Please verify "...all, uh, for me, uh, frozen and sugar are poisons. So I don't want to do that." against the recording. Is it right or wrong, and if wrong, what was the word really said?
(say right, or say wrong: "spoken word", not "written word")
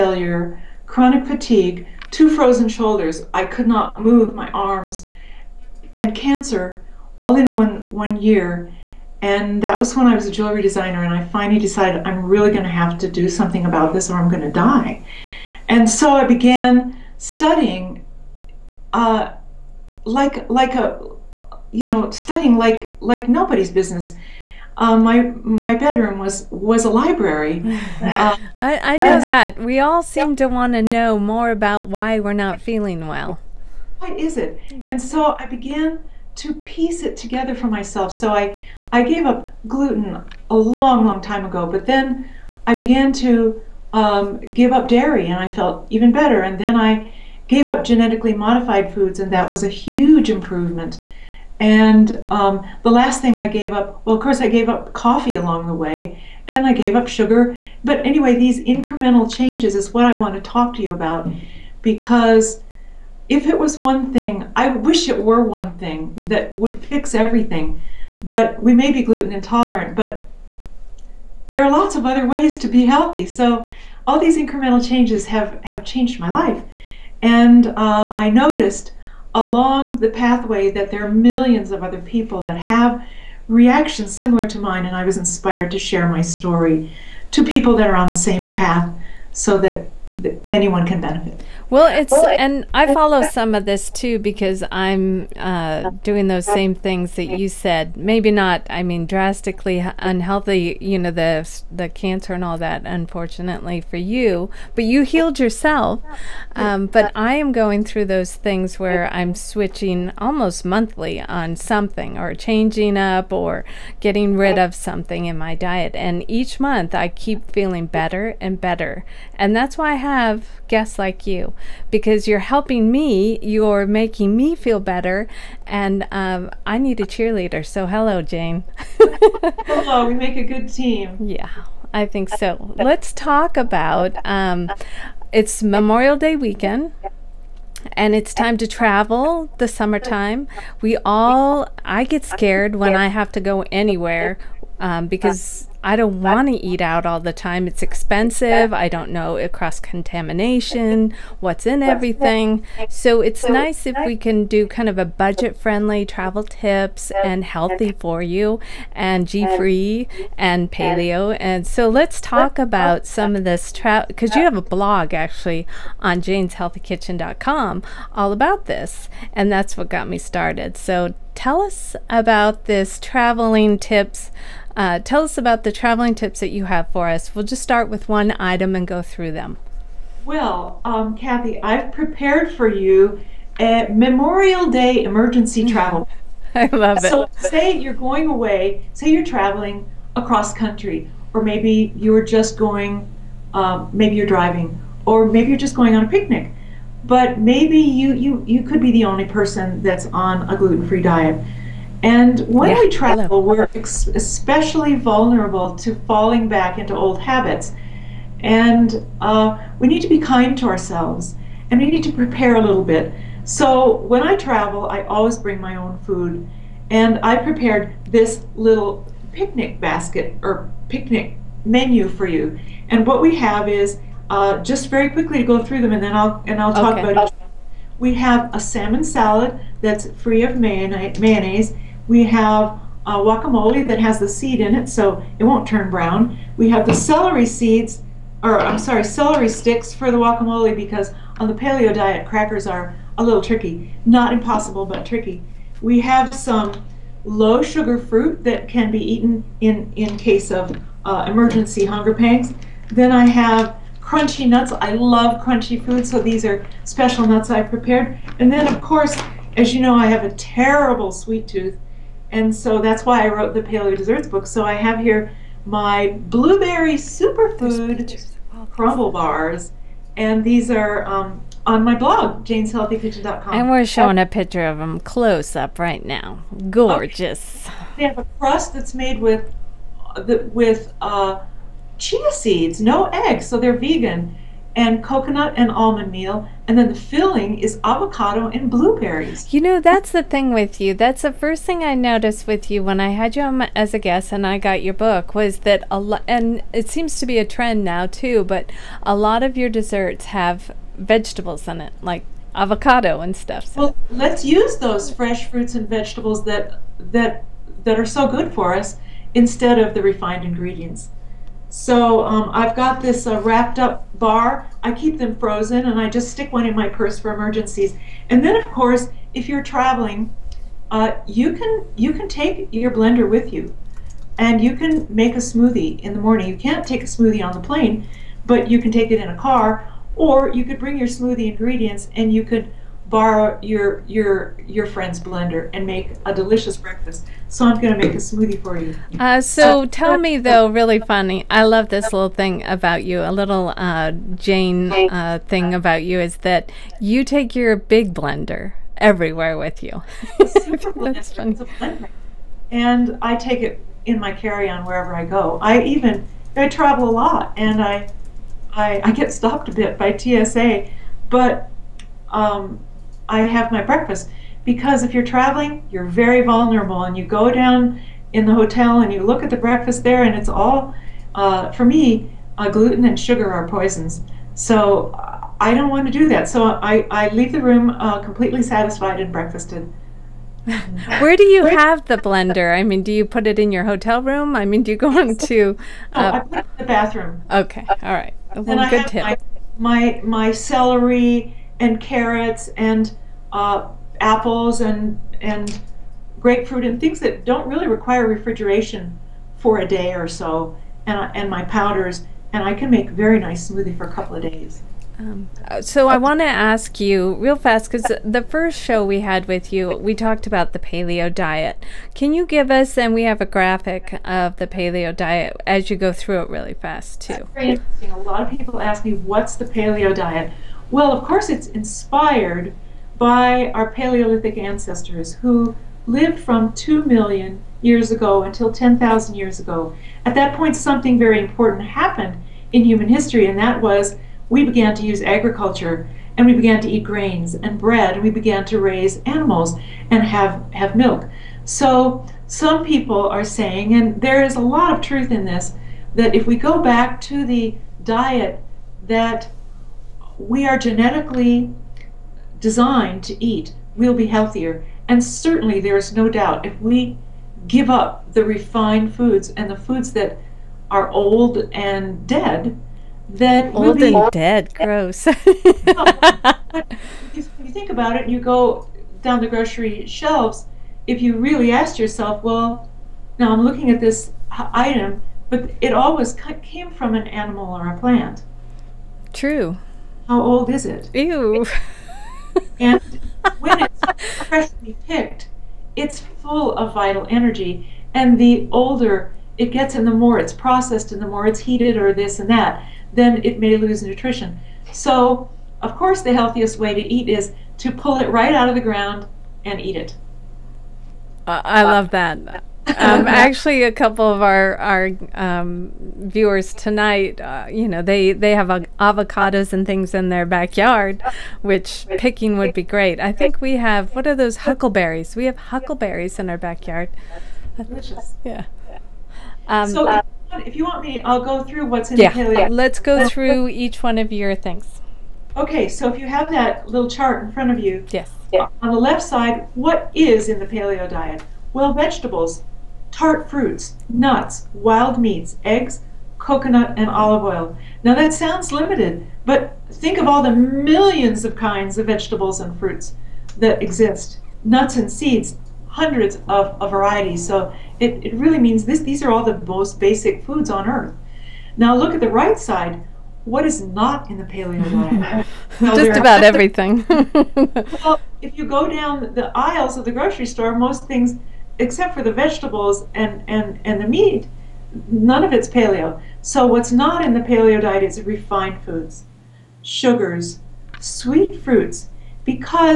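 wrong: "gluten", not "frozen".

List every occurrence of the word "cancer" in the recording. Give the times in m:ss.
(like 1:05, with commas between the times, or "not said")
0:06, 1:41.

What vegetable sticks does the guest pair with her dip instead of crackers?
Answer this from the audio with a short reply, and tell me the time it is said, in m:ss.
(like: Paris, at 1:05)
celery sticks, at 3:59.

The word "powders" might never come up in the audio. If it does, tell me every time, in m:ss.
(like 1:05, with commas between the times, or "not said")
6:41.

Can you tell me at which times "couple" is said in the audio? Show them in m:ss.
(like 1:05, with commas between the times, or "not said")
6:44, 8:23.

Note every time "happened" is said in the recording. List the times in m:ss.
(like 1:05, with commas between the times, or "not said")
7:11.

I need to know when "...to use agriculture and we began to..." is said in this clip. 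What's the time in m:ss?
7:14.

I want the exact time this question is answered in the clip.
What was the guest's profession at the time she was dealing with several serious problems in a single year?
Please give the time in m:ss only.
0:10.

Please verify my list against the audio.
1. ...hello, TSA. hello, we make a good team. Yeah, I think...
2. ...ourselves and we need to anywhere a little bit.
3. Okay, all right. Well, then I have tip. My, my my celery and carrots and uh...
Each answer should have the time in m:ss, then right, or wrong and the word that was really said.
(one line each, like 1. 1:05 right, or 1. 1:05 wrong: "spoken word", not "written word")
1. 2:07 wrong: "Jane", not "TSA"
2. 3:30 wrong: "prepare", not "anywhere"
3. 6:27 right.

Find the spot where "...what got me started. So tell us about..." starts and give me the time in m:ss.
2:49.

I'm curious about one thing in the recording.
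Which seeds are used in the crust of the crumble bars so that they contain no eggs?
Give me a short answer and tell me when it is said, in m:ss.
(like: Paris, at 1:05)
chia seeds, at 4:41.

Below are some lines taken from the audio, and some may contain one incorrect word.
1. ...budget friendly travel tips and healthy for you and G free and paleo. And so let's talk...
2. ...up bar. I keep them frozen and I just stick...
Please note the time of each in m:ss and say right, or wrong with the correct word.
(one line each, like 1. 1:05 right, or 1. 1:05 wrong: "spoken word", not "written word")
1. 2:35 right
2. 5:13 right.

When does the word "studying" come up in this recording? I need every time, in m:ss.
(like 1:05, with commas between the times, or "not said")
0:17, 0:22.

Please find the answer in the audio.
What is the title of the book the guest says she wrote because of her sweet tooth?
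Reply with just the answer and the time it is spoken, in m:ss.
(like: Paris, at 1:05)
Paleo Desserts, at 4:23.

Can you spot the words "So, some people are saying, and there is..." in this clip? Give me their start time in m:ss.
7:21.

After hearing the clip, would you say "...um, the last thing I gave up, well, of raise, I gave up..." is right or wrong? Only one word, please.
wrong.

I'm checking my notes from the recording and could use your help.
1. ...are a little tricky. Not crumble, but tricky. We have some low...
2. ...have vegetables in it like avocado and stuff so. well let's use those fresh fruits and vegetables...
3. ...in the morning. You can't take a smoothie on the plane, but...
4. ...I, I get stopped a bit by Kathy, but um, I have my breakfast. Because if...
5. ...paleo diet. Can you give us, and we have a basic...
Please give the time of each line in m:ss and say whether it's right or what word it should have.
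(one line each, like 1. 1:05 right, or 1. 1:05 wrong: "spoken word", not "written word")
1. 4:02 wrong: "impossible", not "crumble"
2. 5:00 right
3. 5:26 right
4. 5:58 wrong: "TSA", not "Kathy"
5. 6:50 wrong: "graphic", not "basic".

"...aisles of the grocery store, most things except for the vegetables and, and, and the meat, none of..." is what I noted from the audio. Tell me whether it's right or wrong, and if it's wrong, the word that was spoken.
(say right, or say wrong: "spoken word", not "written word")
right.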